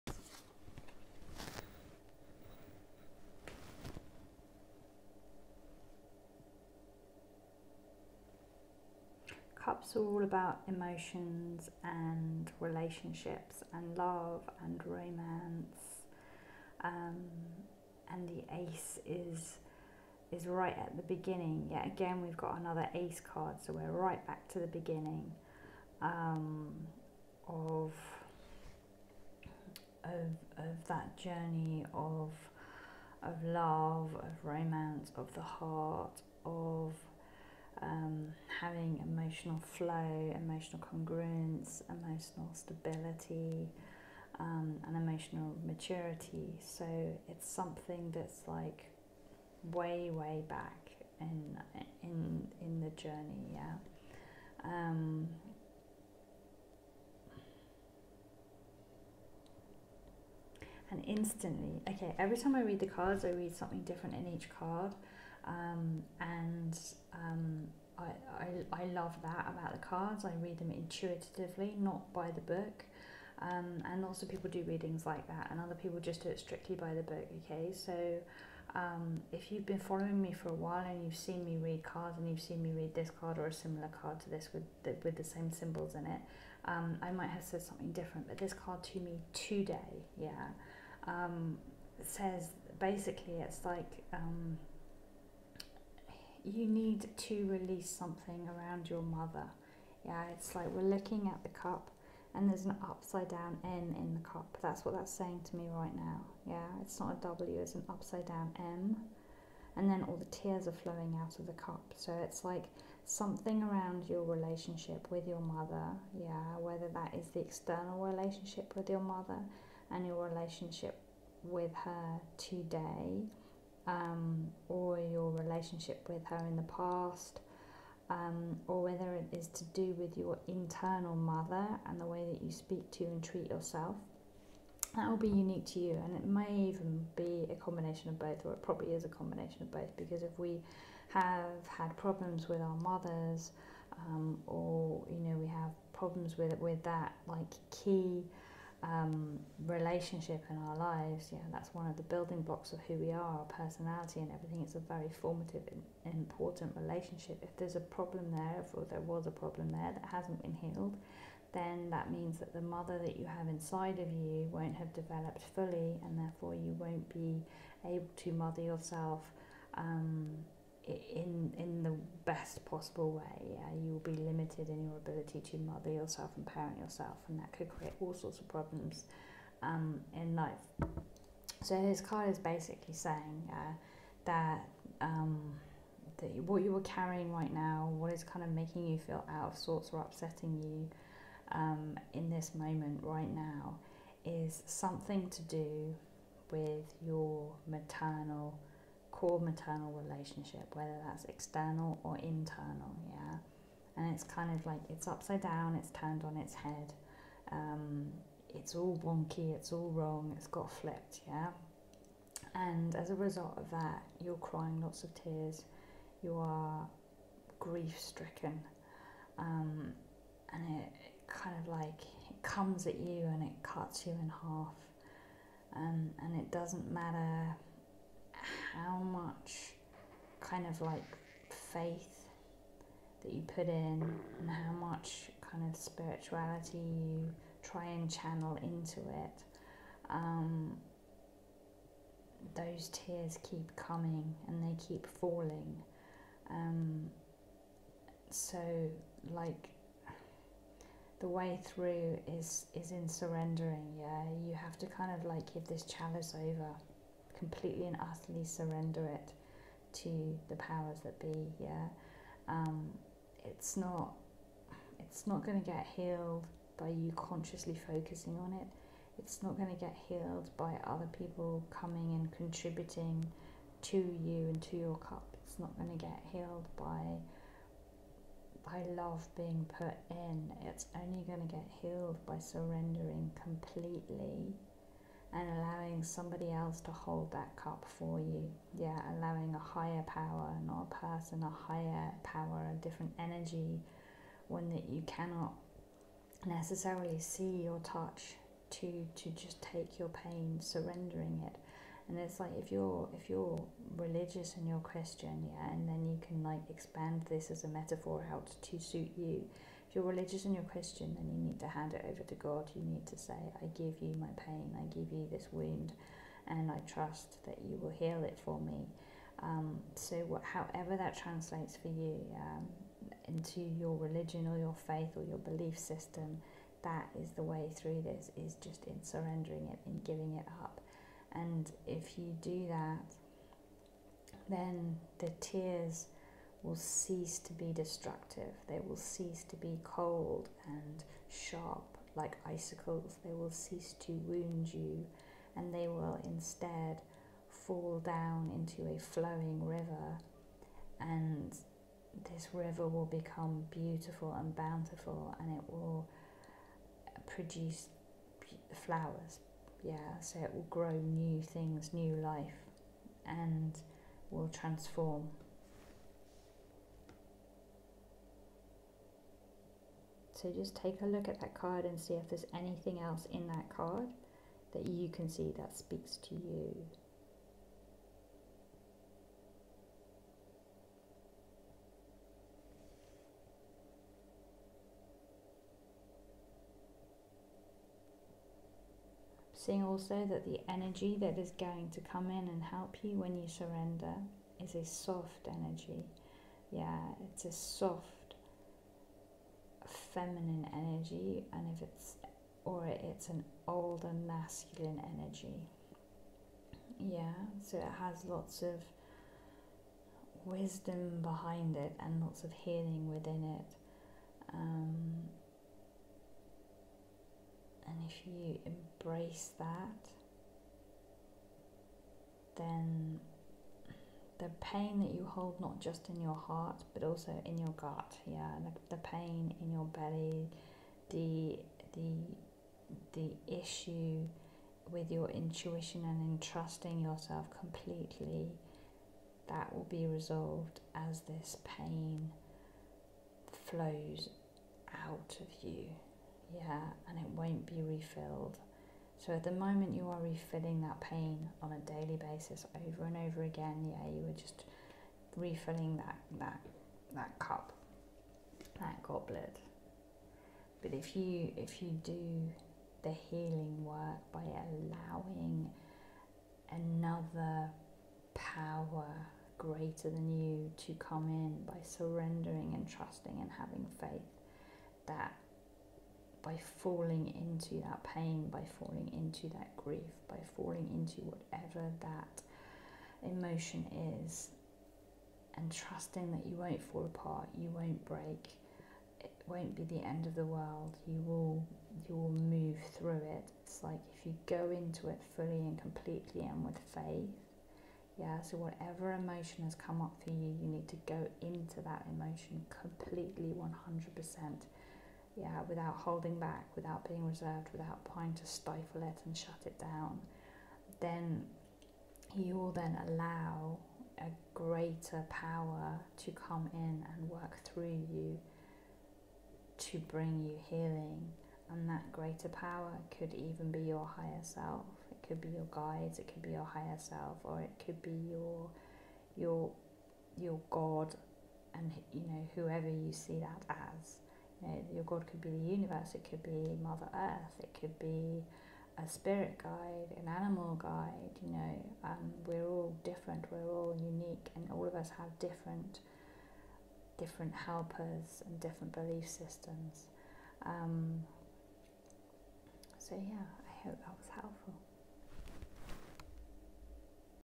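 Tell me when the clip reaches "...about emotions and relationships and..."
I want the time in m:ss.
0:10.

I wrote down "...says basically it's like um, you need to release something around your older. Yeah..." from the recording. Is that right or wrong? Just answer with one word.
wrong.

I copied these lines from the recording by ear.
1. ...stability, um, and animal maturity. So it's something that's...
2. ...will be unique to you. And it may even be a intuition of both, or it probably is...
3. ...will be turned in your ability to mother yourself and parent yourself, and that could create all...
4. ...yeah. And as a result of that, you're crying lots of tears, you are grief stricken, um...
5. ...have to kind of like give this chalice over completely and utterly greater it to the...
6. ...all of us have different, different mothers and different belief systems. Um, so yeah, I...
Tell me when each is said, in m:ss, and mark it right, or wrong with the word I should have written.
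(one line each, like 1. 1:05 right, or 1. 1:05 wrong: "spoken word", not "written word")
1. 0:42 wrong: "emotional", not "animal"
2. 2:15 wrong: "combination", not "intuition"
3. 2:53 wrong: "limited", not "turned"
4. 3:31 right
5. 4:14 wrong: "surrender", not "greater"
6. 9:04 wrong: "helpers", not "mothers".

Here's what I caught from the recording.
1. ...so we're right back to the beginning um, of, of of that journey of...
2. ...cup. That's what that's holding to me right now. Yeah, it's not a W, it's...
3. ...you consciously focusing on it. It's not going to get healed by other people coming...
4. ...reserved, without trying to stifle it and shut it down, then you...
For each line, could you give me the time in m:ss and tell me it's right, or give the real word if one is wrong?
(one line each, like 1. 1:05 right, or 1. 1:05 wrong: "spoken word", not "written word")
1. 0:23 right
2. 1:44 wrong: "saying", not "holding"
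3. 4:26 right
4. 8:27 right.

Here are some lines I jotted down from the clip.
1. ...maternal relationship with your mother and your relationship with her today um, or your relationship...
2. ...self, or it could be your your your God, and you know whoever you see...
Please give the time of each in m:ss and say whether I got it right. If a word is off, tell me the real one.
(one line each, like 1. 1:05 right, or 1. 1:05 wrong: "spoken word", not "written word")
1. 1:57 wrong: "external", not "maternal"
2. 8:46 right.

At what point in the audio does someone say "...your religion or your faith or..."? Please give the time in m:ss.
5:23.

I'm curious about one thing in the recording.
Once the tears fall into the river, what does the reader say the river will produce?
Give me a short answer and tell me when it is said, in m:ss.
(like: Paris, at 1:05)
Flowers, at 5:58.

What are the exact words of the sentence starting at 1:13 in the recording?
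Um, and lots of people do readings like that, and other people just do it strictly by the book.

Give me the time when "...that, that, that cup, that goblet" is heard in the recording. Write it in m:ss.
7:35.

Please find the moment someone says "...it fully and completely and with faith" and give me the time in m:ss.
8:15.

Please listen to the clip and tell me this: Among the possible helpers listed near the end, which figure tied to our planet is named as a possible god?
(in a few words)
Mother Earth.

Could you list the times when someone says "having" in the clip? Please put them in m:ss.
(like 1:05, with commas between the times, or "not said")
0:38, 7:53.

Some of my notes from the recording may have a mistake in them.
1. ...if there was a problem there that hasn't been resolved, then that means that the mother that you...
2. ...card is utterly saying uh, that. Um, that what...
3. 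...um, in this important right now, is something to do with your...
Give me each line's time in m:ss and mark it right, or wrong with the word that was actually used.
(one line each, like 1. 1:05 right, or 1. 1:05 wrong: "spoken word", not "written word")
1. 2:38 wrong: "healed", not "resolved"
2. 3:02 wrong: "basically", not "utterly"
3. 3:11 wrong: "moment", not "important".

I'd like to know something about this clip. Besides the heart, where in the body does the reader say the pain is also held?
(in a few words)
Gut.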